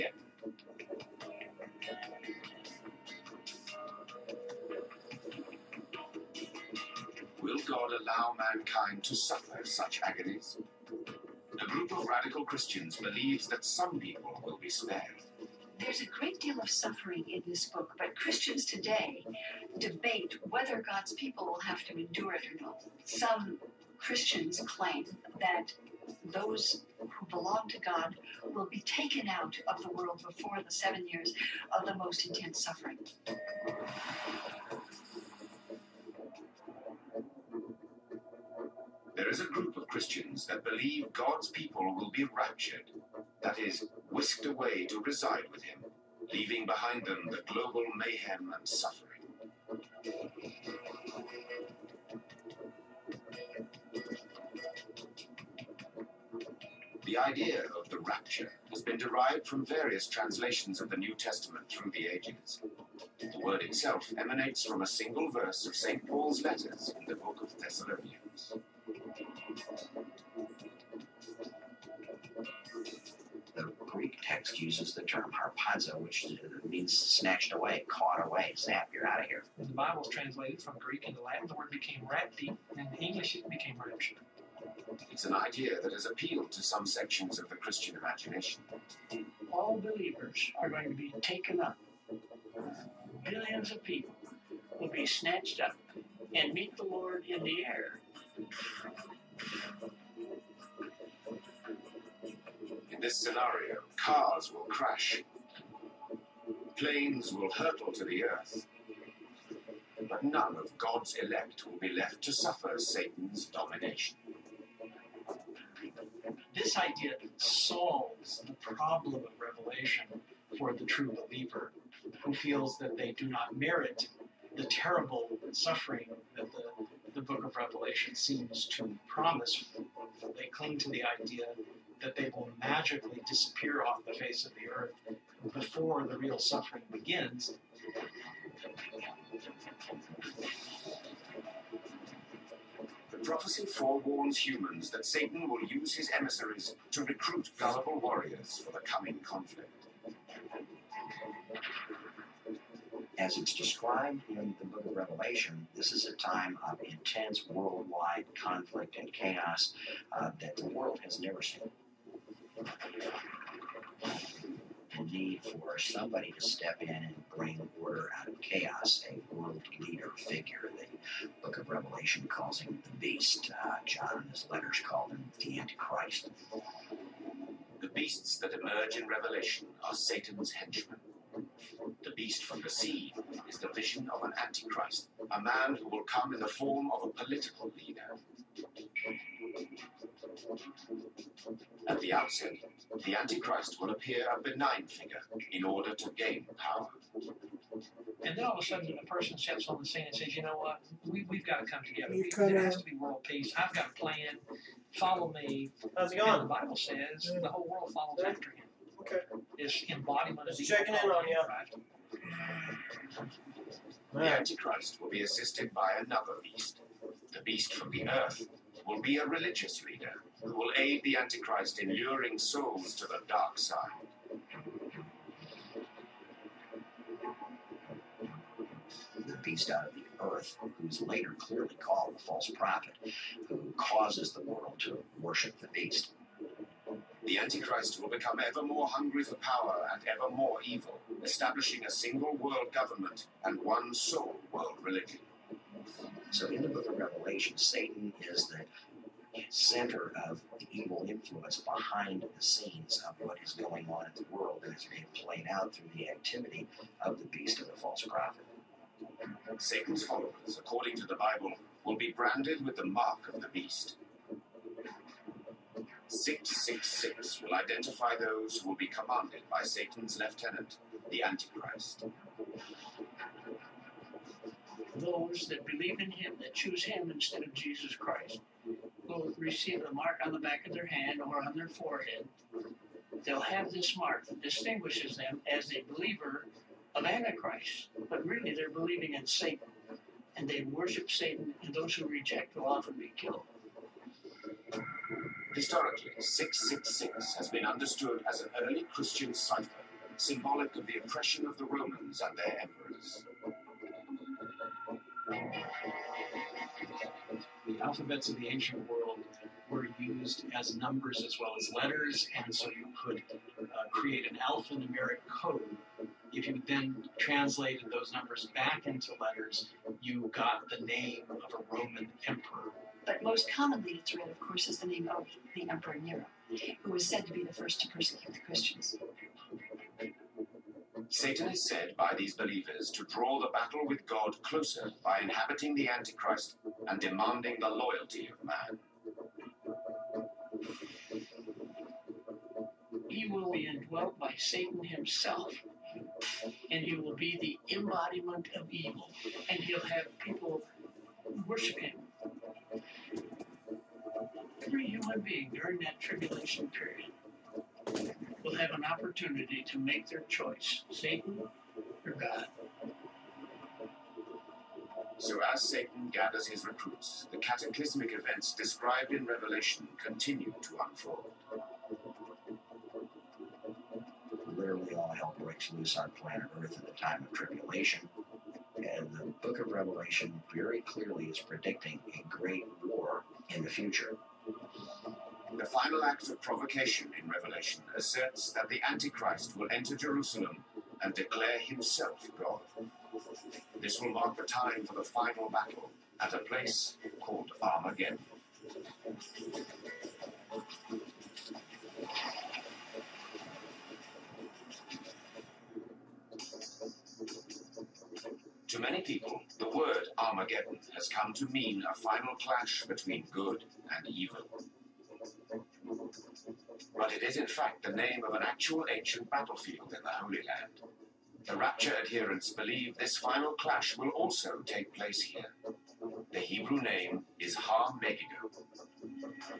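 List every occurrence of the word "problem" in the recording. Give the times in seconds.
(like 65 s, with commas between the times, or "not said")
118 s.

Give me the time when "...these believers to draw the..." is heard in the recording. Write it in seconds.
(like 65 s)
332 s.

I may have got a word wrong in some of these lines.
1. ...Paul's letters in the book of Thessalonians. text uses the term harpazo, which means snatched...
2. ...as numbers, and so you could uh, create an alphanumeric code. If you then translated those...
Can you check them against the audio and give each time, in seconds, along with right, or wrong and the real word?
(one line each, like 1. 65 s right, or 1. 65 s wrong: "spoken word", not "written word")
1. 66 s right
2. 311 s wrong: "letters", not "numbers".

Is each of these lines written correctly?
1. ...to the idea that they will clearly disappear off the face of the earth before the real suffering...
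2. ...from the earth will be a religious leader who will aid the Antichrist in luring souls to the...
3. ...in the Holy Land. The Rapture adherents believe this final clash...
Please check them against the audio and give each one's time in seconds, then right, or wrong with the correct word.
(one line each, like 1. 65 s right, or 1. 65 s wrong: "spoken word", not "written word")
1. 130 s wrong: "magically", not "clearly"
2. 217 s right
3. 419 s right.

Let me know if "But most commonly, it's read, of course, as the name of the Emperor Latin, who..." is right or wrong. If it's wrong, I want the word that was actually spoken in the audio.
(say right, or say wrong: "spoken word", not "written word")
wrong: "Nero", not "Latin".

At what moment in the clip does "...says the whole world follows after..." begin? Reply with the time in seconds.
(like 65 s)
206 s.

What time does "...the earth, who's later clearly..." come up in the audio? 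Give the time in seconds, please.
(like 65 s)
229 s.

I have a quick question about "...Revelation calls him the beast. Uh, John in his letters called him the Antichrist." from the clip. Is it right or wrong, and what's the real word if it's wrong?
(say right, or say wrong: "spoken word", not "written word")
right.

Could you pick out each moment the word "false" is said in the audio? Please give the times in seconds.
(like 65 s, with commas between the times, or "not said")
232 s, 257 s.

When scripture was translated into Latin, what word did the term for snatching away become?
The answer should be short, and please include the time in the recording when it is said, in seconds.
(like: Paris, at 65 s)
rapti, at 82 s.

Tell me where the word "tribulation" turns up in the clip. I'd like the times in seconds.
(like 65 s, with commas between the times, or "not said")
355 s, 377 s.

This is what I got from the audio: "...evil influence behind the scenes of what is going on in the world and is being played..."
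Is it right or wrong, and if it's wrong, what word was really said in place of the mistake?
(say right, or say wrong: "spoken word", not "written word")
right.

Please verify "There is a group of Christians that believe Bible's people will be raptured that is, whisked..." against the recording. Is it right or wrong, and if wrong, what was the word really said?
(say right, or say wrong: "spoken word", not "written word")
wrong: "God", not "Bible".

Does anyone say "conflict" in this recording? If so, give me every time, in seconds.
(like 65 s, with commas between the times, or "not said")
149 s, 158 s.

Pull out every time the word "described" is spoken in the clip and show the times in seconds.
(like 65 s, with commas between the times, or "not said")
153 s, 368 s.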